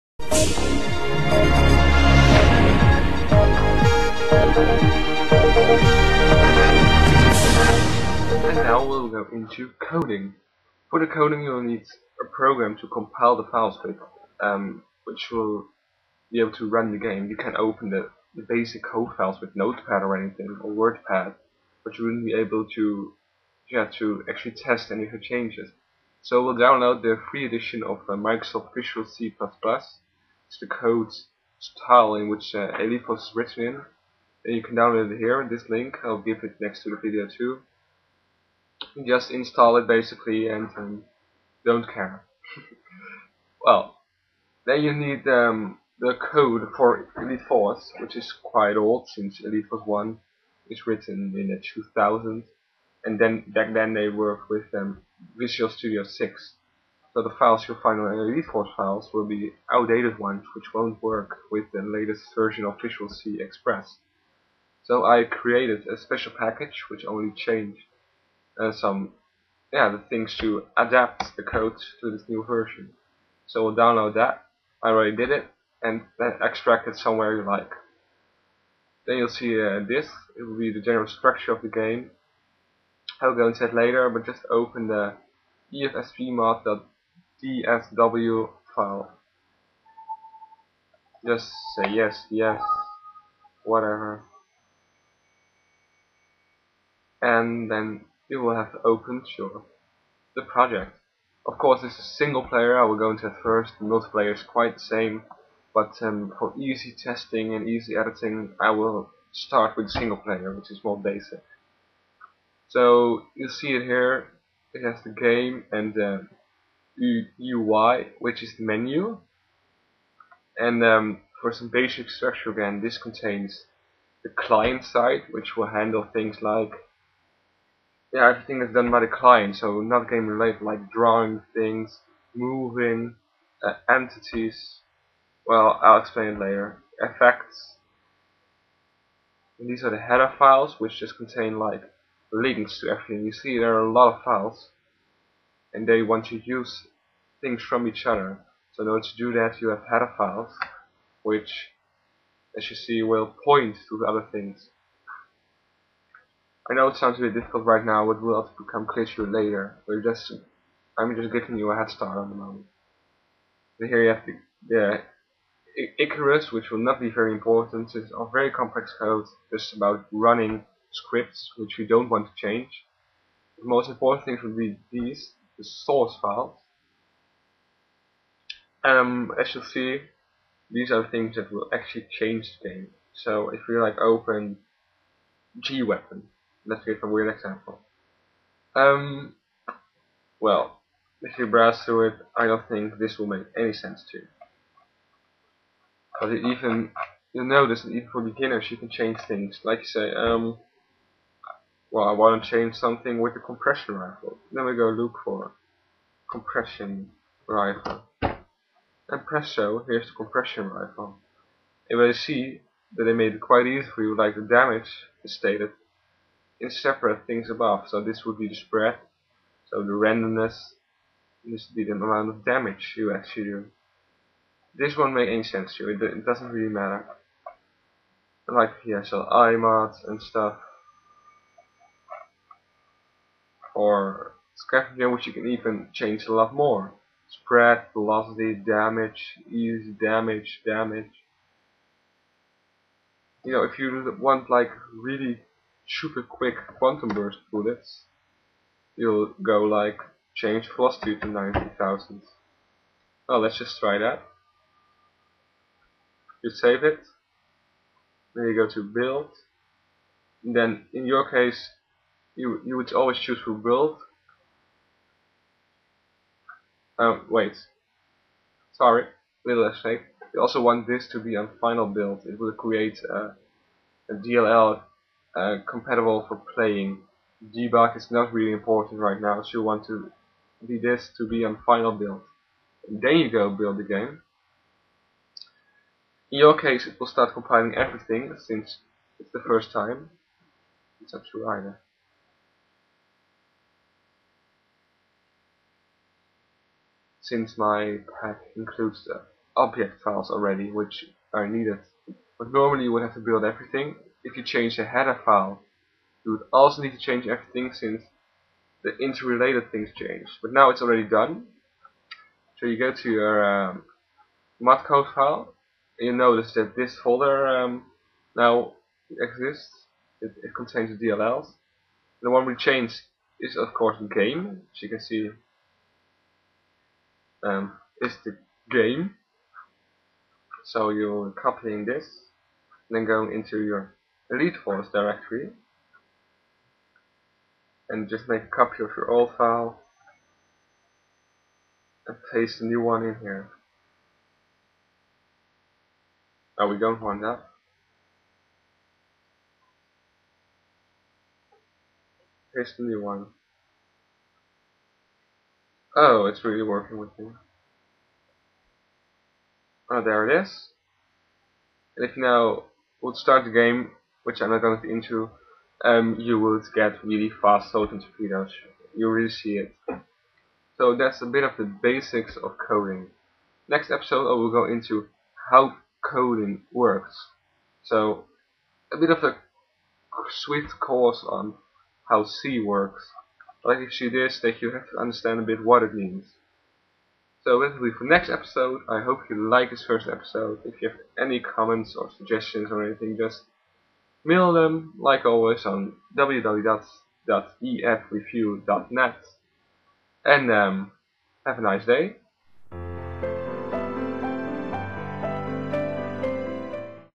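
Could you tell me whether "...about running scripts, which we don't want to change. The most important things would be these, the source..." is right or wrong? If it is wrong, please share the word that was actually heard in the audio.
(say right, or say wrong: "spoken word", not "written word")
right.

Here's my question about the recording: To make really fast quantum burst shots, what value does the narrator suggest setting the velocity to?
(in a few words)
90000.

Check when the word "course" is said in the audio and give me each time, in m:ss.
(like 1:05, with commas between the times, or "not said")
1:41, 5:23, 6:20.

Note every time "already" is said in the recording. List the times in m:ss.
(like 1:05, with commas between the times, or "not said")
1:14, 5:00, 5:10.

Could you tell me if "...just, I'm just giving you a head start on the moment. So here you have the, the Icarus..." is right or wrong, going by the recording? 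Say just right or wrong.
right.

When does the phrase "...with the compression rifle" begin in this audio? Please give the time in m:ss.
3:23.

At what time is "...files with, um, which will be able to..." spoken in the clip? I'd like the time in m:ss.
0:13.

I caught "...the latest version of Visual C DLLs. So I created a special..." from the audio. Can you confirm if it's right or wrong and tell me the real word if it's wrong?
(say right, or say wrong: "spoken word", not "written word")
wrong: "Express", not "DLLs".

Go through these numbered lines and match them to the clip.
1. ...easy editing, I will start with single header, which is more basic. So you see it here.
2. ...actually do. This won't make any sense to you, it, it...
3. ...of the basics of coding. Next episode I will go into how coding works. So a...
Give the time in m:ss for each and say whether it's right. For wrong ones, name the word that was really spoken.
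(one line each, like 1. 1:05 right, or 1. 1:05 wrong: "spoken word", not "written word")
1. 1:47 wrong: "player", not "header"
2. 3:43 right
3. 6:11 right.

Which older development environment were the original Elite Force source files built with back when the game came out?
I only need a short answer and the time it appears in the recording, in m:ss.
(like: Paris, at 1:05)
Visual Studio 6, at 0:55.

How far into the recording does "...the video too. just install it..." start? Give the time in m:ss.
0:36.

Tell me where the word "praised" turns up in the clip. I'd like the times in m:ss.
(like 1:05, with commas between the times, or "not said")
not said.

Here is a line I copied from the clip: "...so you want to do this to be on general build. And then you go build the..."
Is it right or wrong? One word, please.
wrong.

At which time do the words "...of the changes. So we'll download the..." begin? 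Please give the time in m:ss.
0:25.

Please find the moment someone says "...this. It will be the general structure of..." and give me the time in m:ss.
1:19.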